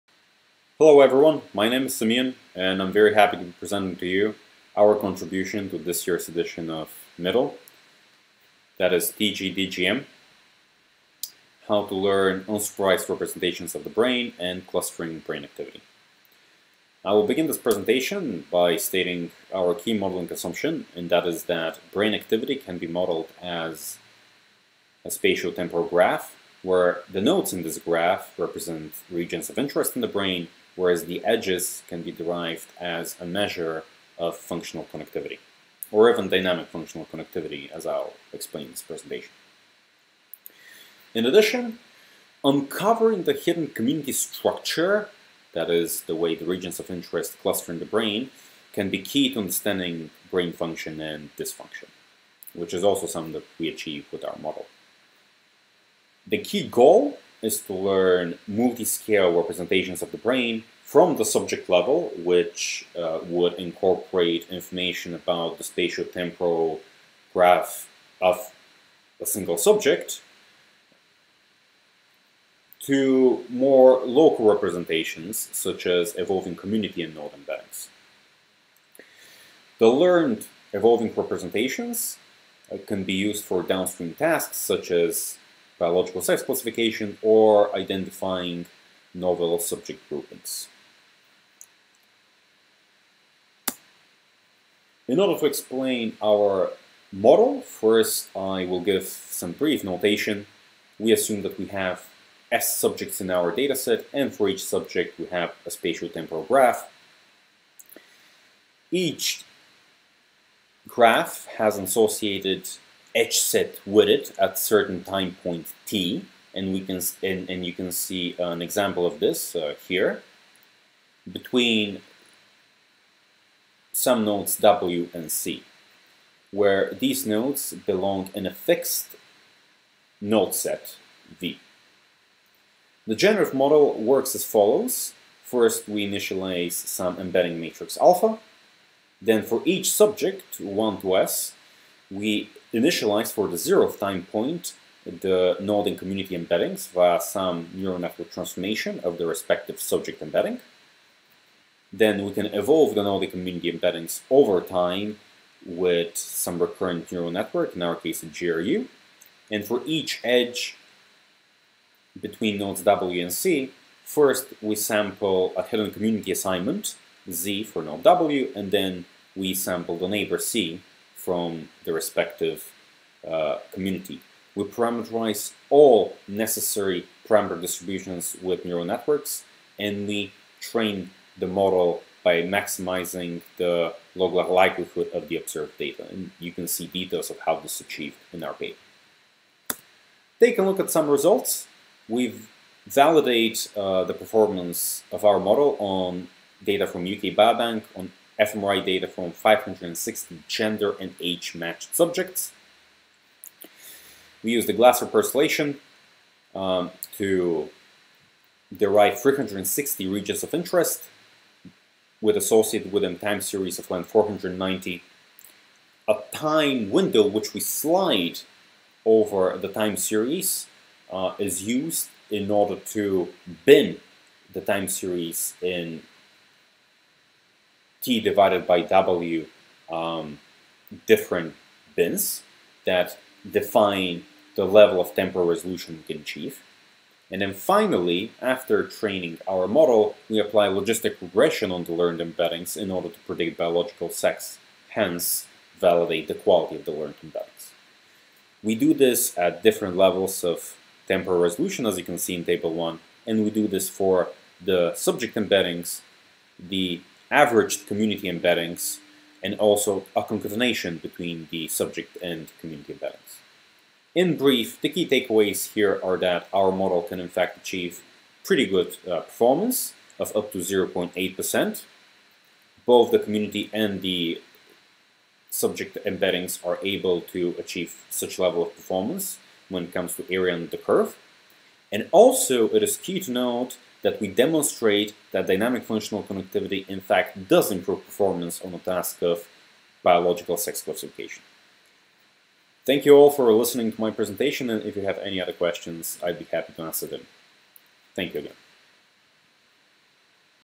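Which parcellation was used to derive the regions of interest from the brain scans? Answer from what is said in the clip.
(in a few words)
Glasser.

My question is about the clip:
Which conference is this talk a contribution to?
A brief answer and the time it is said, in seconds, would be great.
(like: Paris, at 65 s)
MIDL, at 7 s.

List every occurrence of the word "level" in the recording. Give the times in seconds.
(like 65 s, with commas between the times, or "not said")
61 s, 234 s, 249 s, 278 s.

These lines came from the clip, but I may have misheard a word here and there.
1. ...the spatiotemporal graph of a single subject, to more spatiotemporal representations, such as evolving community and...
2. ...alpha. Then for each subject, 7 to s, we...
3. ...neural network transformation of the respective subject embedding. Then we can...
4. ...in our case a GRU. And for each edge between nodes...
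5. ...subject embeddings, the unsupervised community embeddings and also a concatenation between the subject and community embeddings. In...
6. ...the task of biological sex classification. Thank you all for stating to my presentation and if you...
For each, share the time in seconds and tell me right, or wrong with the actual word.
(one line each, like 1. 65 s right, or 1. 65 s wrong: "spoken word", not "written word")
1. 65 s wrong: "local", not "spatiotemporal"
2. 137 s wrong: "1", not "7"
3. 147 s right
4. 157 s right
5. 254 s wrong: "averaged", not "unsupervised"
6. 288 s wrong: "listening", not "stating".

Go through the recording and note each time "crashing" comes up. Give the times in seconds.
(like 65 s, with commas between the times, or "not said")
not said.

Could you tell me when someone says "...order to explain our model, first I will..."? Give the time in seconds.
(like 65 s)
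95 s.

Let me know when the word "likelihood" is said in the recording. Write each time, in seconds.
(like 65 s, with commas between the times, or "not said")
184 s.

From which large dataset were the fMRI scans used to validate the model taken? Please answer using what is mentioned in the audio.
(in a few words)
UK Biobank.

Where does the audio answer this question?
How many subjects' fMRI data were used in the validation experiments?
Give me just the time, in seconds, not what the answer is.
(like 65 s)
199 s.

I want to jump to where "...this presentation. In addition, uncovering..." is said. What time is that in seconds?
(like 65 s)
38 s.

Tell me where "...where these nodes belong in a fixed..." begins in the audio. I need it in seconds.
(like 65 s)
126 s.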